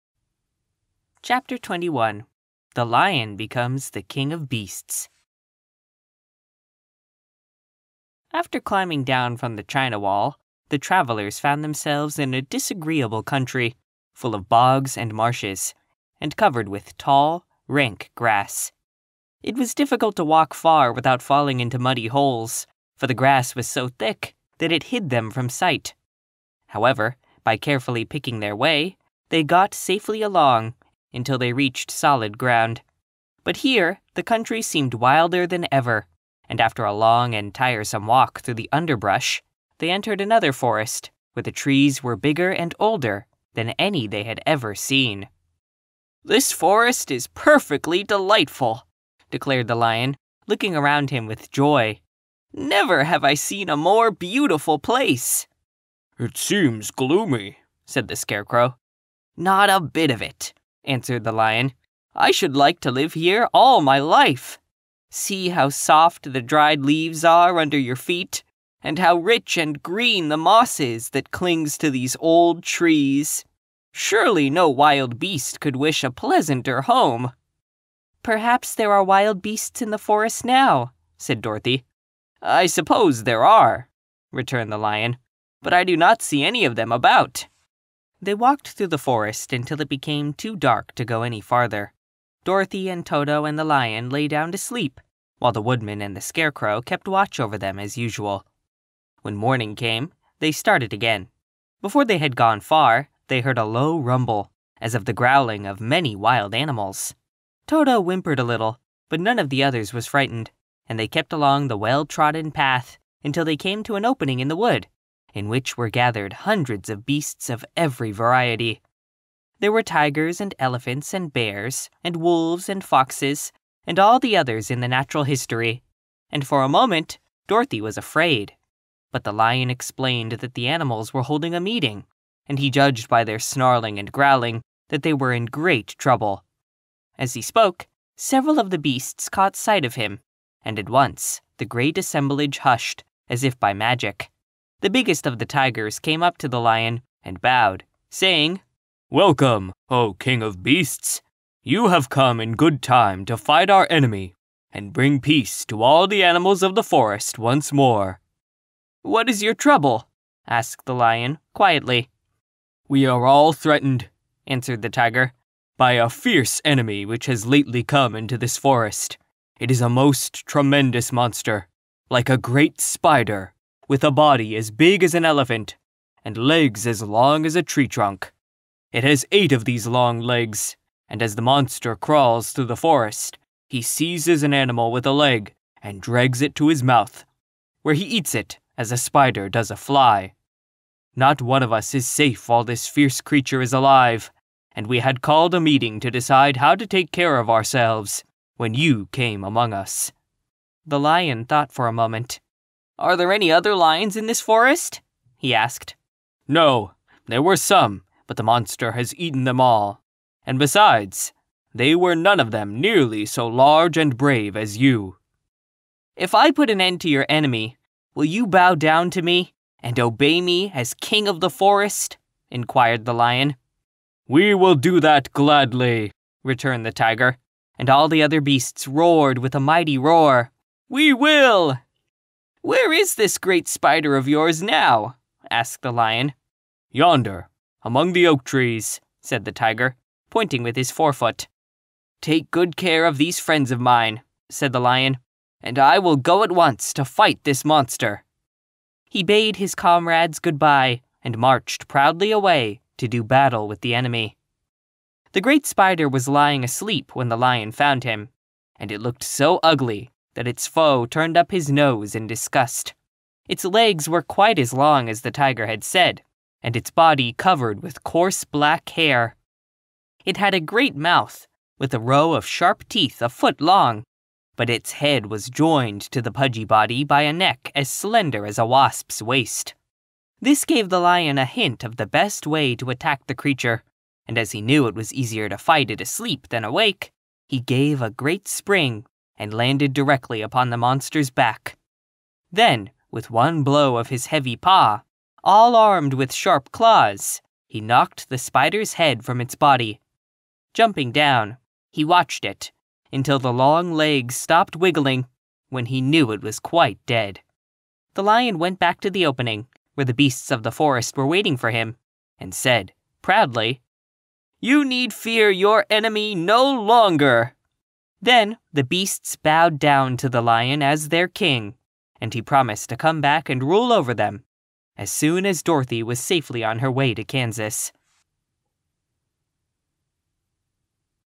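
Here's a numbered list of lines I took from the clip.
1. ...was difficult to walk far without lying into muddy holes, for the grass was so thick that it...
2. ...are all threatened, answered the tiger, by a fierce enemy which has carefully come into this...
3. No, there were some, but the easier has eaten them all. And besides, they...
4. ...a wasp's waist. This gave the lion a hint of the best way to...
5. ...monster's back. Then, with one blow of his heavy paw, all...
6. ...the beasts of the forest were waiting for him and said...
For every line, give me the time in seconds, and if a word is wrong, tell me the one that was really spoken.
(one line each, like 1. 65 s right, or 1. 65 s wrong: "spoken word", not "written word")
1. 19 s wrong: "falling", not "lying"
2. 163 s wrong: "lately", not "carefully"
3. 206 s wrong: "monster", not "easier"
4. 278 s right
5. 290 s right
6. 310 s right.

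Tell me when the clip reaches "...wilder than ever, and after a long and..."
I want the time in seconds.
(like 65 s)
34 s.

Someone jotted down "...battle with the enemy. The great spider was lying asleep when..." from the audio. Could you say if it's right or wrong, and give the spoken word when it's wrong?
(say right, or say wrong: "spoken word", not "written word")
right.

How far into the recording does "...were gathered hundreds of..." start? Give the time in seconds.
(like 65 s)
115 s.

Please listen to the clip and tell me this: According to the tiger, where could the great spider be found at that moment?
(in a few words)
among the oak trees.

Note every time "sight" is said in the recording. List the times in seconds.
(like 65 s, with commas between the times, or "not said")
25 s, 139 s.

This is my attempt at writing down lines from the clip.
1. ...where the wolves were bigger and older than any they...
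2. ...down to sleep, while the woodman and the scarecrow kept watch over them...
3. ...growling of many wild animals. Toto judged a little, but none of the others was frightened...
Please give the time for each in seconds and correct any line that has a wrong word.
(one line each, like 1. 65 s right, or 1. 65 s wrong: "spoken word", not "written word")
1. 41 s wrong: "trees", not "wolves"
2. 94 s right
3. 105 s wrong: "whimpered", not "judged".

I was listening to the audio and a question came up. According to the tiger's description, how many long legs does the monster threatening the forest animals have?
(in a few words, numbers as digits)
8.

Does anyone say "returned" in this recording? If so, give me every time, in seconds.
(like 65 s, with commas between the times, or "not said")
84 s, 226 s.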